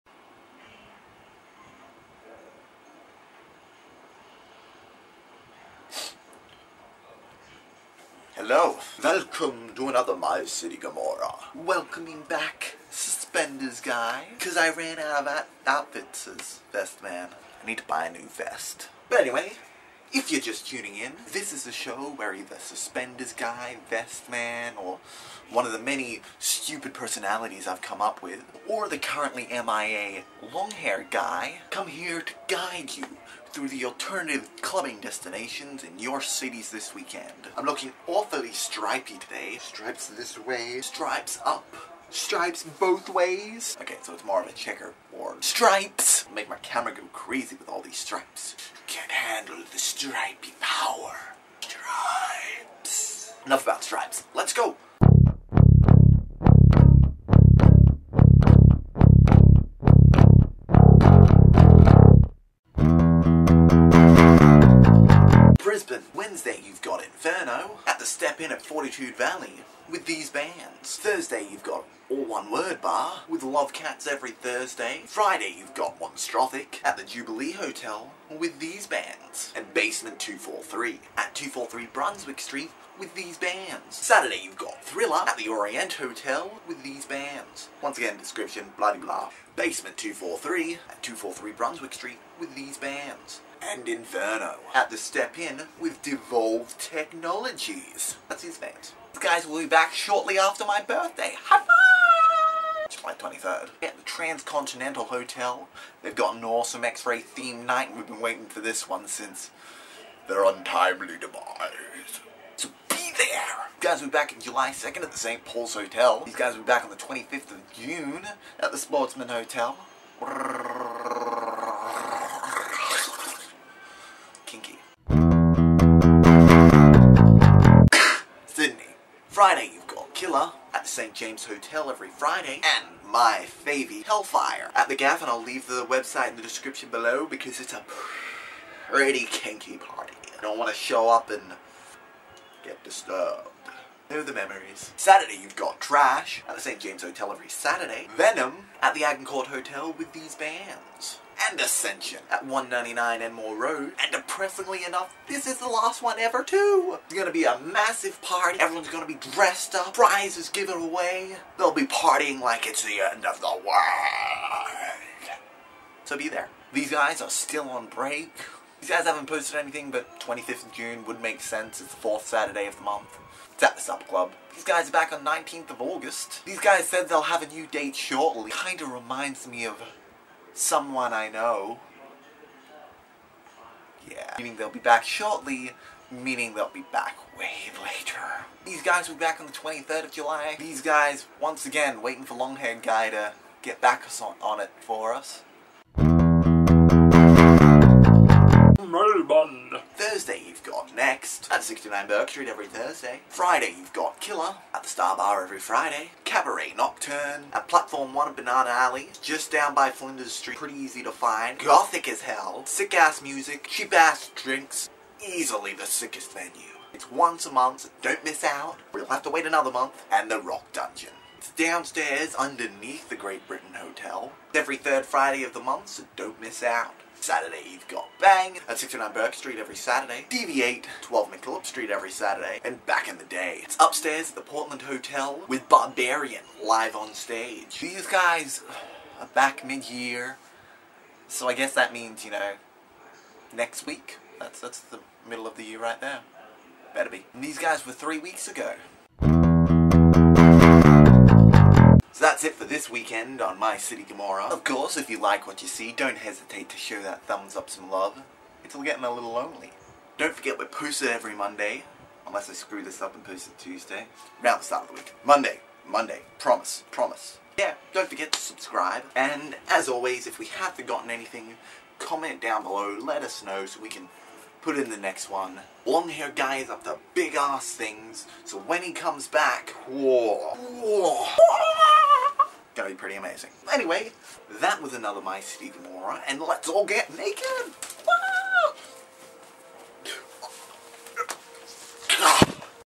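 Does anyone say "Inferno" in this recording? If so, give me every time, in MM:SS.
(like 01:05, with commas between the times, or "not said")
01:07, 01:33.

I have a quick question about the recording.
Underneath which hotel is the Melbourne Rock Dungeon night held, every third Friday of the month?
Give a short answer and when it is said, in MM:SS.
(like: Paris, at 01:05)
Great Britain Hotel, at 03:43.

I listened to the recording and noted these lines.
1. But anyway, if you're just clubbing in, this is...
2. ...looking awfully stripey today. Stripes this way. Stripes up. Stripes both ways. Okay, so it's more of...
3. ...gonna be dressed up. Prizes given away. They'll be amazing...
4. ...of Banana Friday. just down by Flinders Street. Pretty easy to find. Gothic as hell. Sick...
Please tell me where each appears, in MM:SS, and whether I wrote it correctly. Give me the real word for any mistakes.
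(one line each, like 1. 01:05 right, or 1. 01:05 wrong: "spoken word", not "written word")
1. 00:19 wrong: "tuning", not "clubbing"
2. 00:37 right
3. 02:38 wrong: "partying", not "amazing"
4. 03:28 wrong: "Alley", not "Friday".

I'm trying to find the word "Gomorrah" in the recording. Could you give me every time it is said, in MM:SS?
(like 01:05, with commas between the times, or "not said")
00:10, 04:14, 04:45.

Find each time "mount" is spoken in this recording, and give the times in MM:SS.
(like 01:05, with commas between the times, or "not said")
not said.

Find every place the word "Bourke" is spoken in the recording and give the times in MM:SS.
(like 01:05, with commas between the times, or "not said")
03:22, 03:49.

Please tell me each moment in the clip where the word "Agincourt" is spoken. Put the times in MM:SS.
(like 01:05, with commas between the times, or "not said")
02:29.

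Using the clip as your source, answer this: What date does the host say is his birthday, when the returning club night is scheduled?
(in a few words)
July 23rd.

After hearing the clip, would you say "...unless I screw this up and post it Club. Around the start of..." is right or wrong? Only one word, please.
wrong.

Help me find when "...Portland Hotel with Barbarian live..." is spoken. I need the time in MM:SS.
03:54.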